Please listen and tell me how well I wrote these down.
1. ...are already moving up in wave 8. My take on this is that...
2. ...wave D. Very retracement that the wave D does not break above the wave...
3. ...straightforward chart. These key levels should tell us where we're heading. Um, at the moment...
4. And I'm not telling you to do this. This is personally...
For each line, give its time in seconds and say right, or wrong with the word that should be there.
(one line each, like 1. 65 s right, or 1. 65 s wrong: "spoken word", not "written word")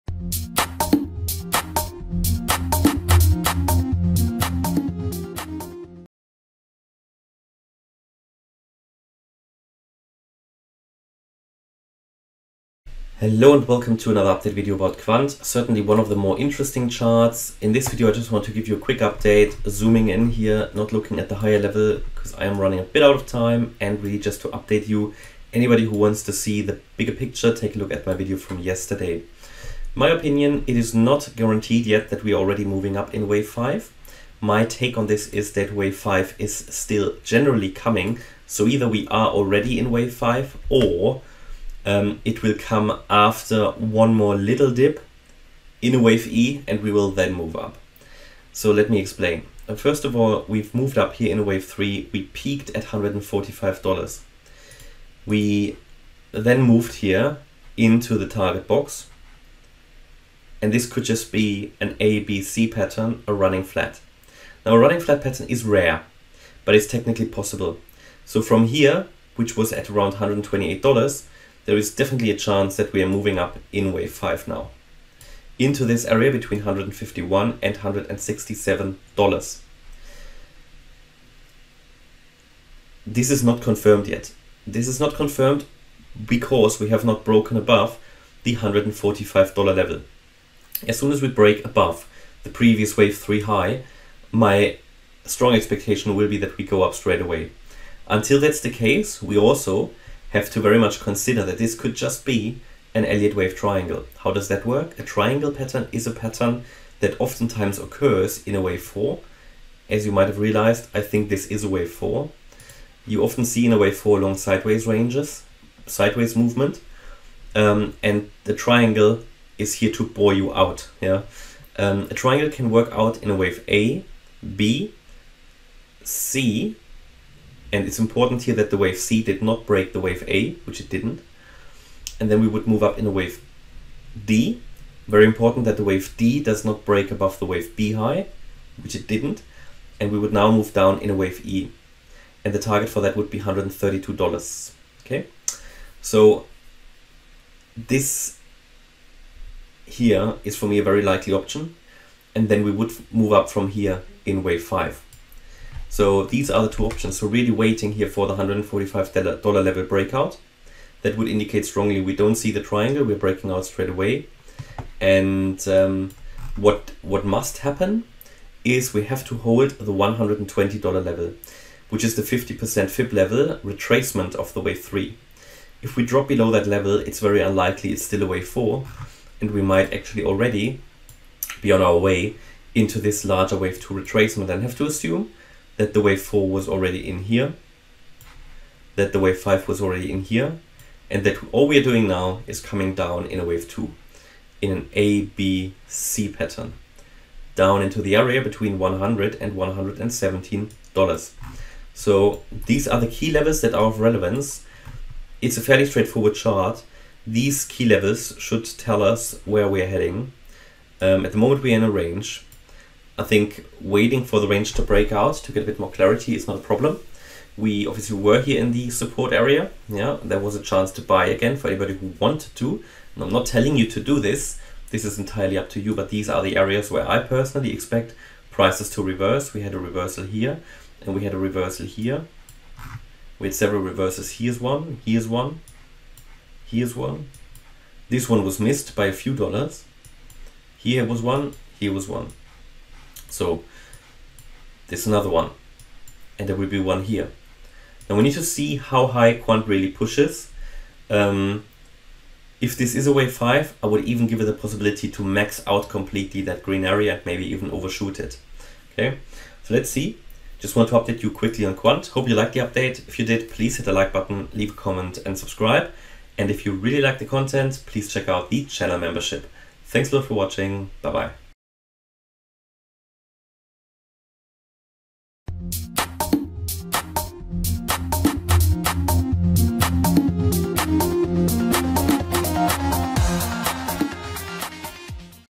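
1. 32 s wrong: "5", not "8"
2. 133 s wrong: "important", not "retracement"
3. 205 s right
4. 223 s wrong: "entirely", not "personally".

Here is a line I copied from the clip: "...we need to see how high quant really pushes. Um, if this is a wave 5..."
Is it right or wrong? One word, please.
right.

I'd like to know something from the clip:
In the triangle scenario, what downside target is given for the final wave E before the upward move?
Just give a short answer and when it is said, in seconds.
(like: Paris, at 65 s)
$132, at 143 s.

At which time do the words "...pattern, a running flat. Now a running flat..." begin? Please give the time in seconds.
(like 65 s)
62 s.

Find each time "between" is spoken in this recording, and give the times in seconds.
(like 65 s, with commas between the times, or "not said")
76 s, 198 s.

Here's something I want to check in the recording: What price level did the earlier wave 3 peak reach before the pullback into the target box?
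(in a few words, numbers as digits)
$145.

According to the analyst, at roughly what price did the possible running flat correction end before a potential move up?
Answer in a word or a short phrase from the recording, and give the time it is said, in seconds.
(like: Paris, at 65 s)
$128, at 70 s.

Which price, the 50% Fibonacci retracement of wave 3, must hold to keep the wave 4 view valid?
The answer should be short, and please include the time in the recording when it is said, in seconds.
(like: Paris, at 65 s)
$120, at 169 s.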